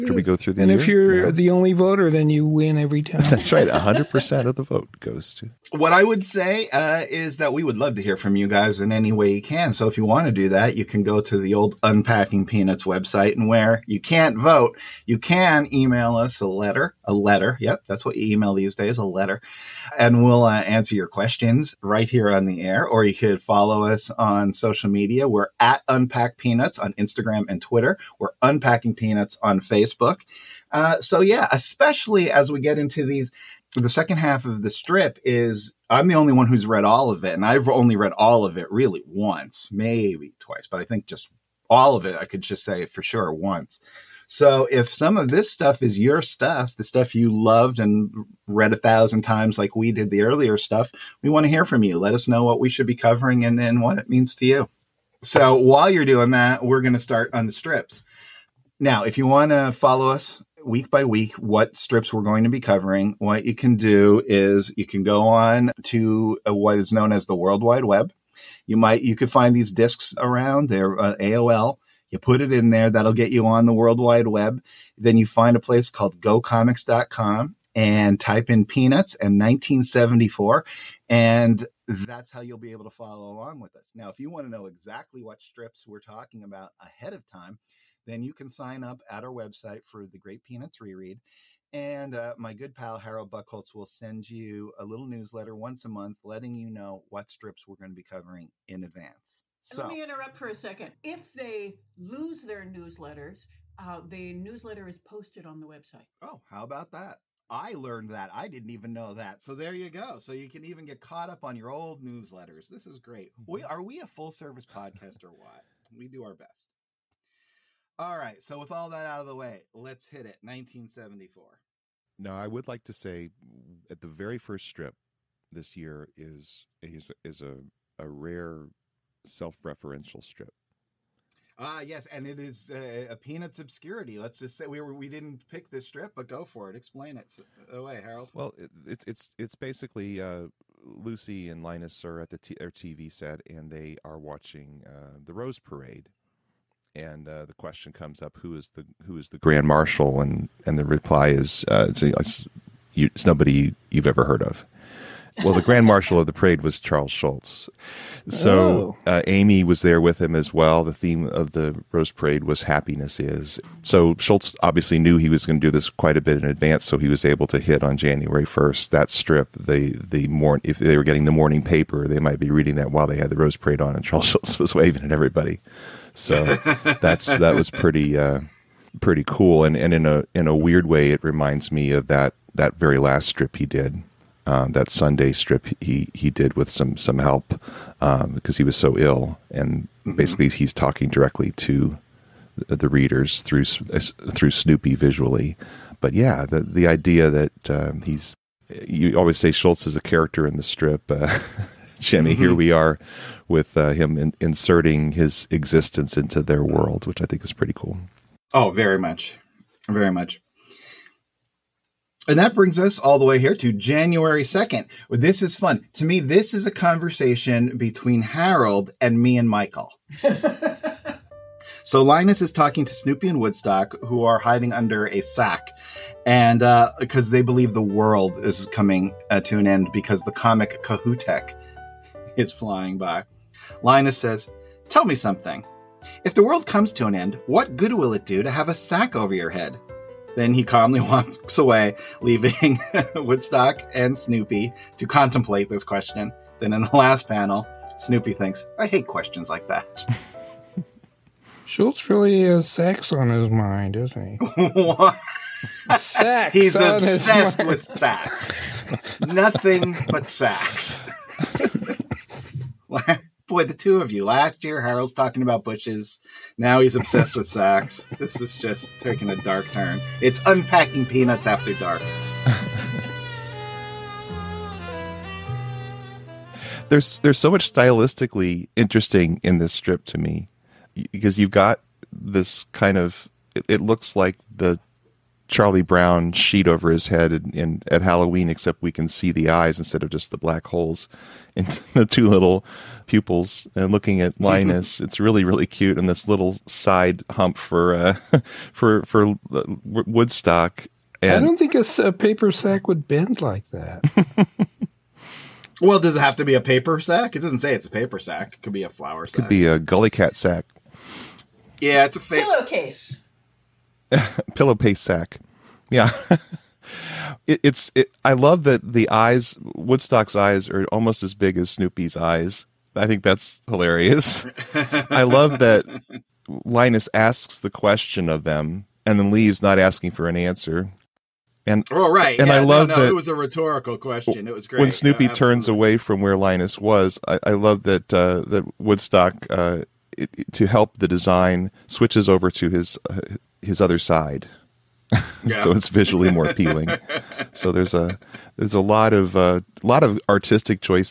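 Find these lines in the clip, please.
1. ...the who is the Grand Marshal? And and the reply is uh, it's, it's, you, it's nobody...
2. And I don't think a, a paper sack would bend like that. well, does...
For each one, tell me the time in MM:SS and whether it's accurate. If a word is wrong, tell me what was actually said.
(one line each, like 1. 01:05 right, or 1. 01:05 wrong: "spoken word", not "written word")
1. 02:28 right
2. 05:01 right.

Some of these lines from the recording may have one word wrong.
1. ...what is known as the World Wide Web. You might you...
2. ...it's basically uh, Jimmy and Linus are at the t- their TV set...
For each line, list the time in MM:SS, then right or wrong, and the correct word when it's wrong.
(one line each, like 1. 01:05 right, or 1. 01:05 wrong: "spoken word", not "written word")
1. 01:06 right
2. 02:19 wrong: "Lucy", not "Jimmy".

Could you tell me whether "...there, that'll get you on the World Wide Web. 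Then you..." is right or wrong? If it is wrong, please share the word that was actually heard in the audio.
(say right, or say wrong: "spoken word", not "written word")
right.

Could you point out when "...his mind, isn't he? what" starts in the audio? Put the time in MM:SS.
04:13.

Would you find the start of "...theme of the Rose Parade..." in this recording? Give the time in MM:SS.
02:40.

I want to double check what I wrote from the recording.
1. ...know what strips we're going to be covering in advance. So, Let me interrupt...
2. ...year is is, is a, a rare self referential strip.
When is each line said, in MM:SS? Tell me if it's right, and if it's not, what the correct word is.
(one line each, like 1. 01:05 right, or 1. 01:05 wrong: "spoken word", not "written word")
1. 01:36 right
2. 02:05 right.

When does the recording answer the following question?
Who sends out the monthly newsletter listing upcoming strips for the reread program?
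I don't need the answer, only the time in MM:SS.
01:32.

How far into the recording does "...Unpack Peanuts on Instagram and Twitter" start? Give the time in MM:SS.
00:25.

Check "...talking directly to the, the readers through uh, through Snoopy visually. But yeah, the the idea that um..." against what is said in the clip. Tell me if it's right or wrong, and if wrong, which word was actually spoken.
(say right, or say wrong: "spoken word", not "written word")
right.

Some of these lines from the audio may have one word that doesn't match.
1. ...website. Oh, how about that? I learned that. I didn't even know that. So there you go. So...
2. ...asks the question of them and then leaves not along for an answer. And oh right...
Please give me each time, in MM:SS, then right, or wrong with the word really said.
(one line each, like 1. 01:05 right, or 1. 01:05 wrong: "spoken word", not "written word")
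1. 01:45 right
2. 05:27 wrong: "asking", not "along".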